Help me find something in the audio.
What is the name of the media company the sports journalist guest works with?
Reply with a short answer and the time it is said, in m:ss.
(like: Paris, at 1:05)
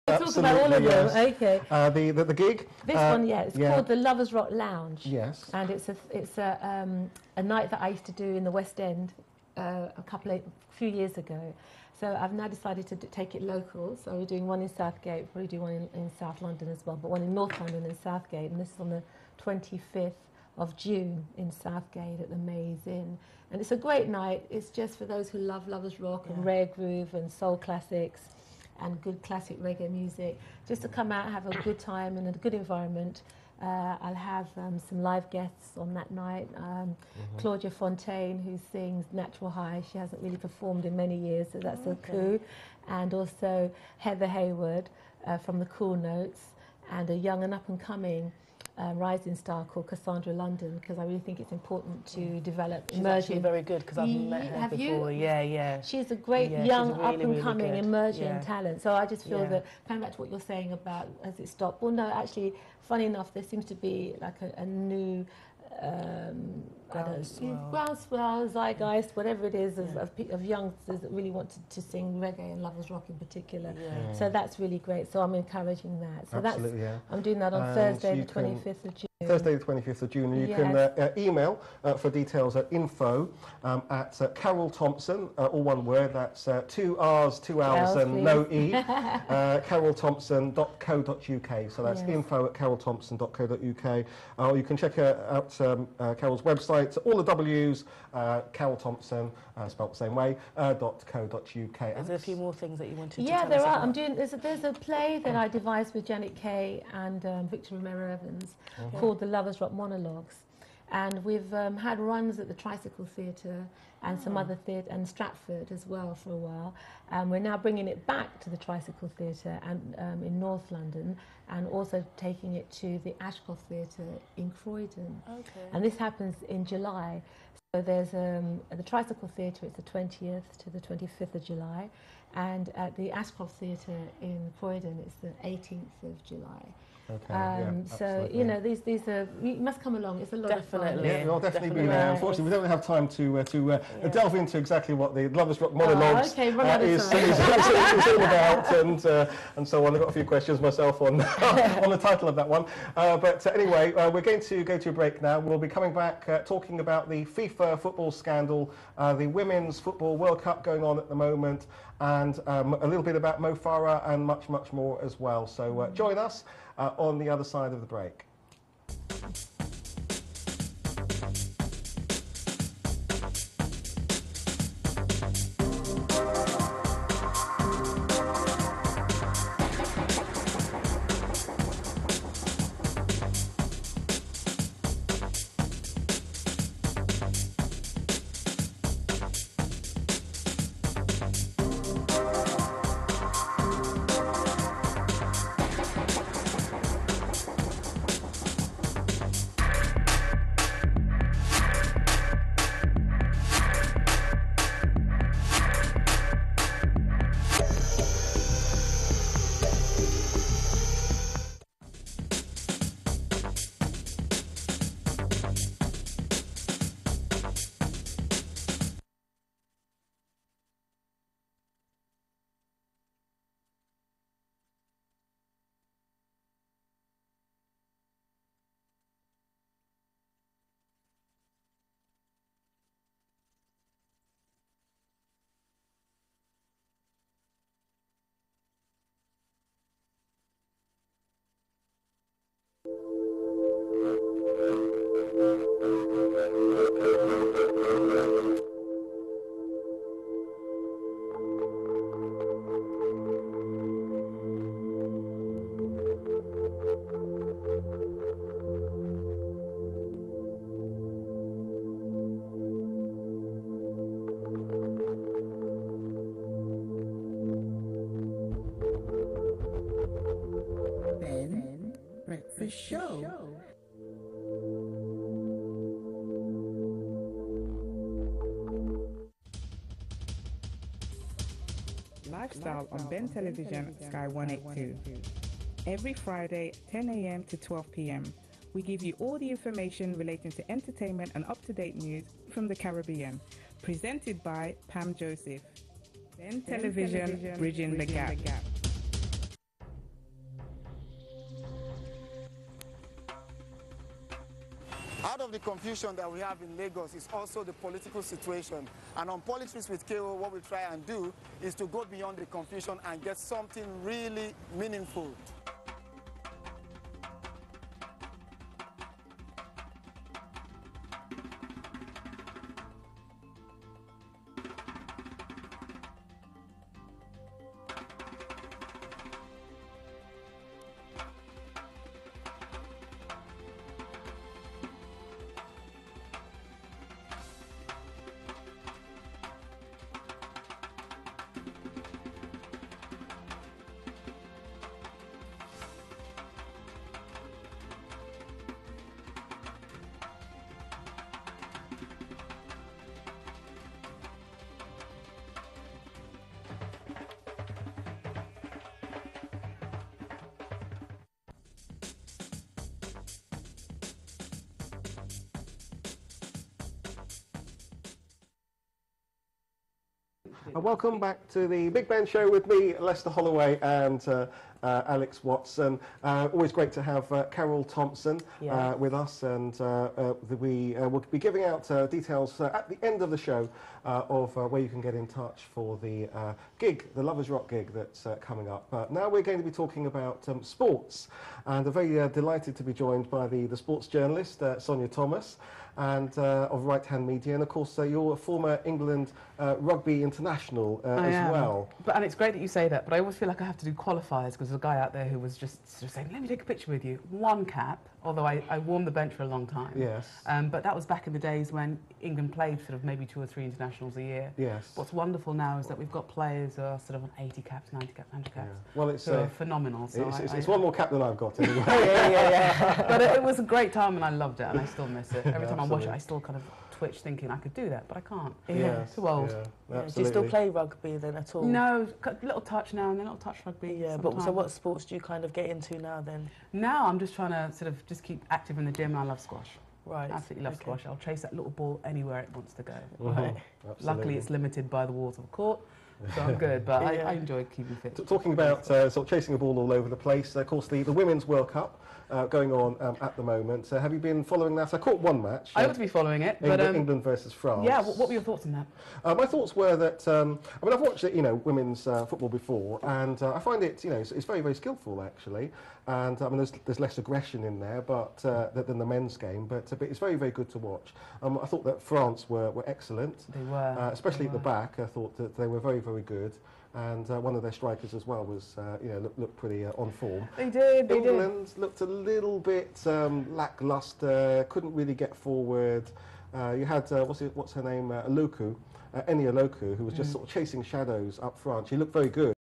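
Right Hand Media, at 6:36.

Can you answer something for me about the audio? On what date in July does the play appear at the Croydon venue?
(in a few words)
18th of July.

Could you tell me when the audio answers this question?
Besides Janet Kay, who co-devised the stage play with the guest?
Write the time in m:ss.
1:47.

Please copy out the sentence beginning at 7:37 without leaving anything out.
Yeah, what, were your thoughts on that?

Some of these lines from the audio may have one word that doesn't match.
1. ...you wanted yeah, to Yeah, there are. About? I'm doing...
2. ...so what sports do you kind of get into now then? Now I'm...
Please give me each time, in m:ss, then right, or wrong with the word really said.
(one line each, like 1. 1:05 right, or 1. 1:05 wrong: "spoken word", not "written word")
1. 1:42 right
2. 7:14 right.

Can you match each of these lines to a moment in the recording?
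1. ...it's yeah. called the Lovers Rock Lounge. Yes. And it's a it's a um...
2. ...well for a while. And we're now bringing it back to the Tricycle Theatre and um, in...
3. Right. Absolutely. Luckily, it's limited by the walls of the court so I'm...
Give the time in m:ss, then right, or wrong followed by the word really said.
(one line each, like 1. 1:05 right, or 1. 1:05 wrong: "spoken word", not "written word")
1. 0:03 right
2. 1:55 right
3. 7:23 right.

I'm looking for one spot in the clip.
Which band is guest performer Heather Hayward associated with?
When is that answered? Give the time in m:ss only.
0:45.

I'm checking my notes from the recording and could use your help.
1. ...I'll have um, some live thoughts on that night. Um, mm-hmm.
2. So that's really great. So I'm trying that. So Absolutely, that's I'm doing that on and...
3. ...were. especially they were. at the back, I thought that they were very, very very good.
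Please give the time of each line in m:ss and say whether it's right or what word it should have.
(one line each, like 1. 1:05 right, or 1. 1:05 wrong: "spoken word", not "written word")
1. 0:34 wrong: "guests", not "thoughts"
2. 1:14 wrong: "encouraging", not "trying"
3. 7:53 right.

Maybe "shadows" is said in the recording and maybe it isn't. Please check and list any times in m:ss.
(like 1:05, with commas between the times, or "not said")
8:10.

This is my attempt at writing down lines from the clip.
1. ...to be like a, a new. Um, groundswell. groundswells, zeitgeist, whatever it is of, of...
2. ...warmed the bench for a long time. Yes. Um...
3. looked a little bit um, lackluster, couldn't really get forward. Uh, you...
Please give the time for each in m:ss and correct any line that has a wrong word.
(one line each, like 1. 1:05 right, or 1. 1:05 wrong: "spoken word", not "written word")
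1. 1:03 right
2. 6:48 right
3. 8:01 right.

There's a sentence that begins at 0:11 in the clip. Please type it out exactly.
So I've now decided to take it local.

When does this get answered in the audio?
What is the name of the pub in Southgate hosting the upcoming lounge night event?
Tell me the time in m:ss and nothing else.
0:22.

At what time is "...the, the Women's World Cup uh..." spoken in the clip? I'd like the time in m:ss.
7:30.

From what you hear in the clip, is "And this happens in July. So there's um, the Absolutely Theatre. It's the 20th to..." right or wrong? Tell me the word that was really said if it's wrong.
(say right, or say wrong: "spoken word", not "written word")
wrong: "Tricycle", not "Absolutely".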